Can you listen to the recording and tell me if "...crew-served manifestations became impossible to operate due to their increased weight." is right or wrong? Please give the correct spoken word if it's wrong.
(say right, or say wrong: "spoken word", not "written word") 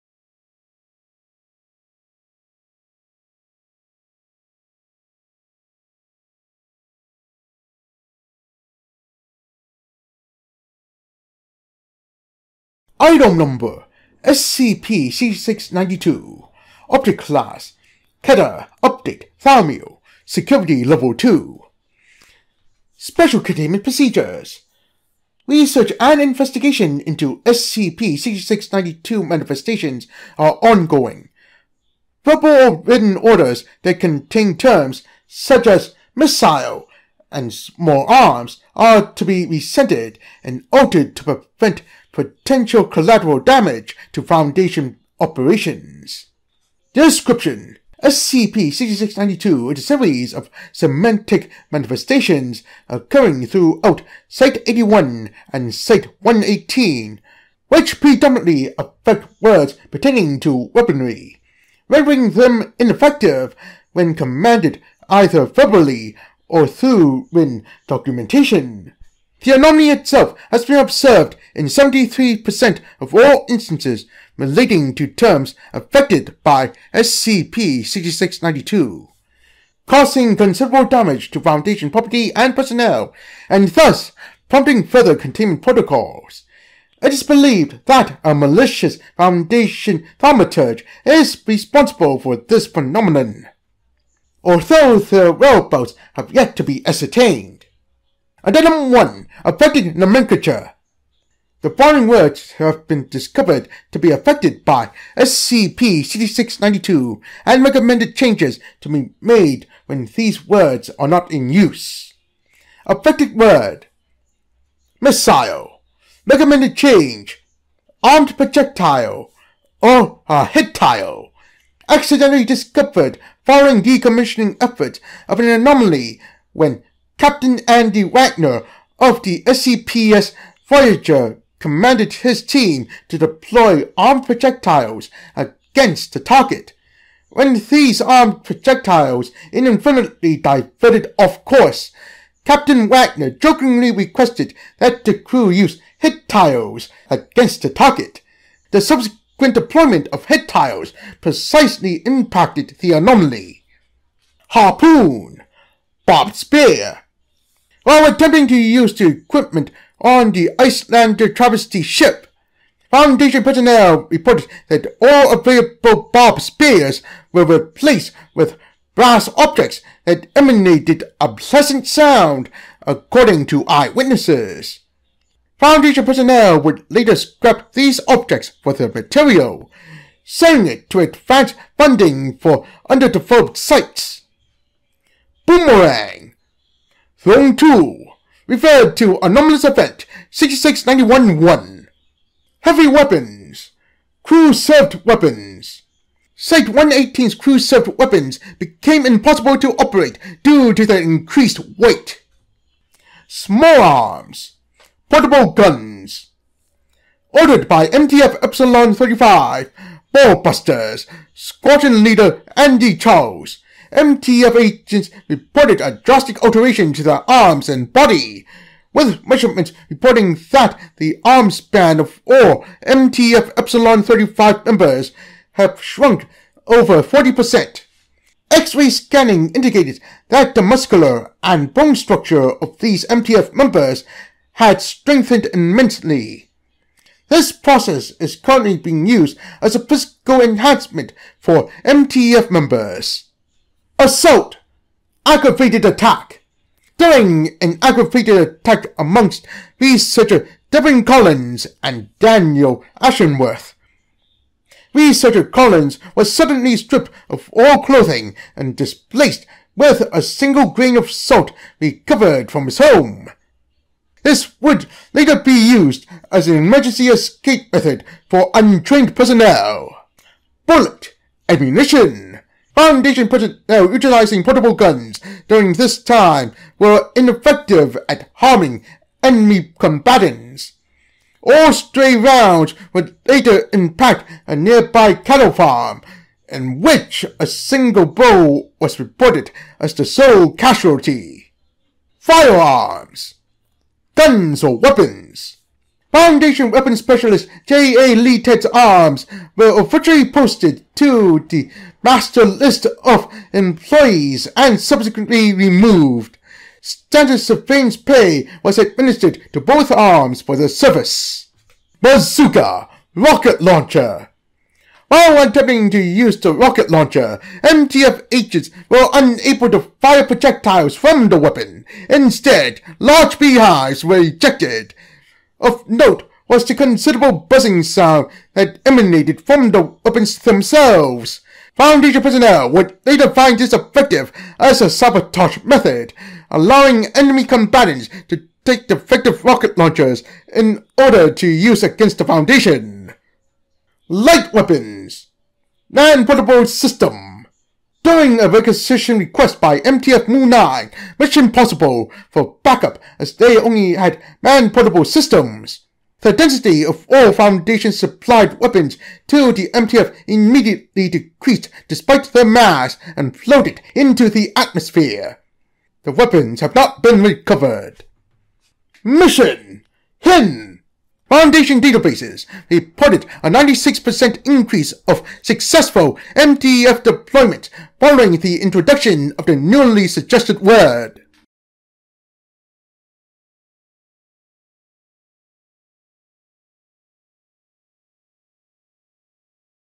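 wrong: "weapons", not "manifestations".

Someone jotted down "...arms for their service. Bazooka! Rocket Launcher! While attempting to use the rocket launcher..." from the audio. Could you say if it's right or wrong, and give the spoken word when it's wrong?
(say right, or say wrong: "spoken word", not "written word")
right.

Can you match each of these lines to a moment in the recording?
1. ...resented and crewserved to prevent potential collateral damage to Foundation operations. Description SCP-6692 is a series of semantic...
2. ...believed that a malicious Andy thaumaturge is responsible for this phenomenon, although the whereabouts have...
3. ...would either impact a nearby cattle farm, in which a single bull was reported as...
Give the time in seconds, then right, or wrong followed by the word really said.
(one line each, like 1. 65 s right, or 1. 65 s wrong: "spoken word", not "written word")
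1. 39 s wrong: "altered", not "crewserved"
2. 87 s wrong: "Foundation", not "Andy"
3. 282 s wrong: "later", not "either".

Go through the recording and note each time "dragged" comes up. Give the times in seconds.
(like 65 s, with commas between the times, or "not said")
not said.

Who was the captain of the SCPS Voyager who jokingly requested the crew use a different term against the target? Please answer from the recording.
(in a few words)
Andy Wagner.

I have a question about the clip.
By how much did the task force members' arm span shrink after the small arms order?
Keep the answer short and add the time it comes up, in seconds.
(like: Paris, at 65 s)
over 40%, at 226 s.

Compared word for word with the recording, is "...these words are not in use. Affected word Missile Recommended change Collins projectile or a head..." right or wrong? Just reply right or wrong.
wrong.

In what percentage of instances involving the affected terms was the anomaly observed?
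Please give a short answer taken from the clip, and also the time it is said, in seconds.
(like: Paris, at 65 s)
73%, at 71 s.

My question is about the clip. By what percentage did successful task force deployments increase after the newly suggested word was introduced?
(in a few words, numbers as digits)
96%.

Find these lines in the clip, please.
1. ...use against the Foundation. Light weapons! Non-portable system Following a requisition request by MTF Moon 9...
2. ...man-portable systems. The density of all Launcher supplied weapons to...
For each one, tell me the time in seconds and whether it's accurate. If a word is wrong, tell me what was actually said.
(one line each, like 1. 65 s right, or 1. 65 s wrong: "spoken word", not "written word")
1. 341 s right
2. 354 s wrong: "Foundation", not "Launcher".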